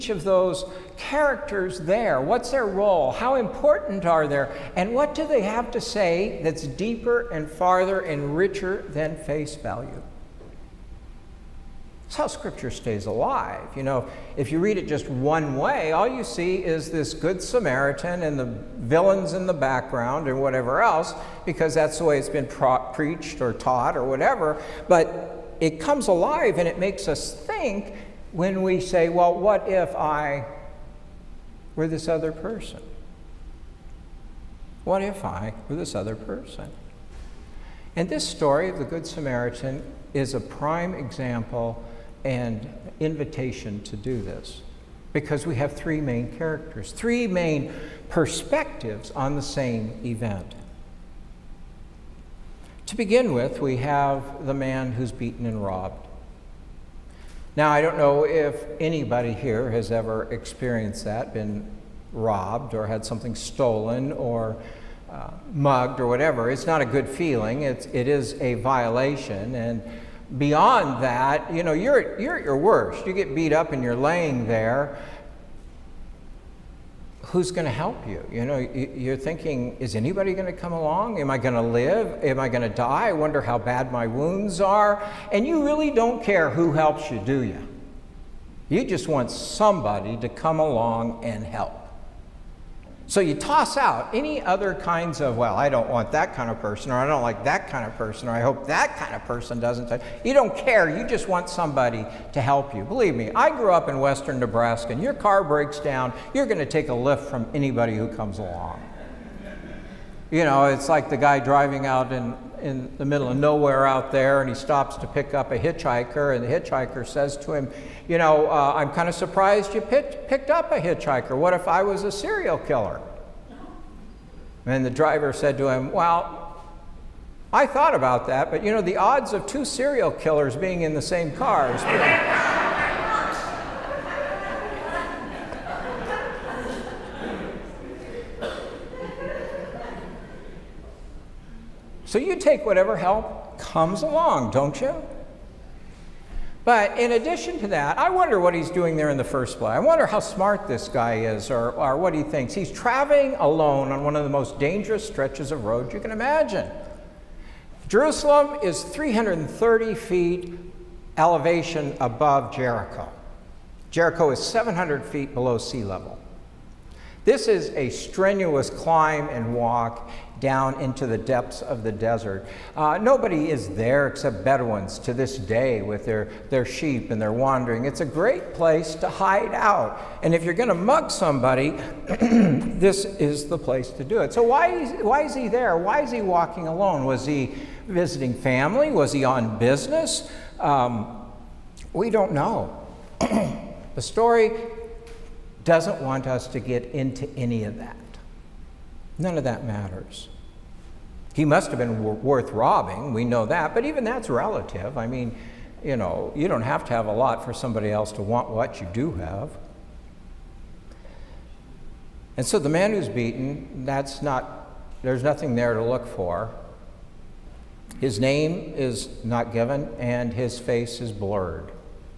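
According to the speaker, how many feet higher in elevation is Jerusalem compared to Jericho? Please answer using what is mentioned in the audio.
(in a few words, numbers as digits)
330 feet.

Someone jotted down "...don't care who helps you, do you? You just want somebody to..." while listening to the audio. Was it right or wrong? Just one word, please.
right.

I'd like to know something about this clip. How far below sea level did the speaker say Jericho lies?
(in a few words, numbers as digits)
700 feet.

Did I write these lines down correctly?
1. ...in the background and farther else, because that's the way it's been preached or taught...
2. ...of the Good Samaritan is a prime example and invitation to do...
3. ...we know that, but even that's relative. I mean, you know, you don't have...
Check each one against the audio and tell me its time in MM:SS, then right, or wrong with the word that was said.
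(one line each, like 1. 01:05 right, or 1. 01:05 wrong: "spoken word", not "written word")
1. 00:19 wrong: "whatever", not "farther"
2. 00:38 right
3. 03:23 right.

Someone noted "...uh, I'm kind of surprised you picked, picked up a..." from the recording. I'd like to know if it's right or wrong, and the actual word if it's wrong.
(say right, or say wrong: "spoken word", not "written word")
right.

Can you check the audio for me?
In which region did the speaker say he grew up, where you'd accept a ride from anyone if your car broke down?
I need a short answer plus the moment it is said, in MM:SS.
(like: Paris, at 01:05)
western Nebraska, at 01:43.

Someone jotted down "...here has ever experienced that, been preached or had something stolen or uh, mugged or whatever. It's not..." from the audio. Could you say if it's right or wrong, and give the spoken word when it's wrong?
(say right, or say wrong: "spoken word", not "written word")
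wrong: "robbed", not "preached".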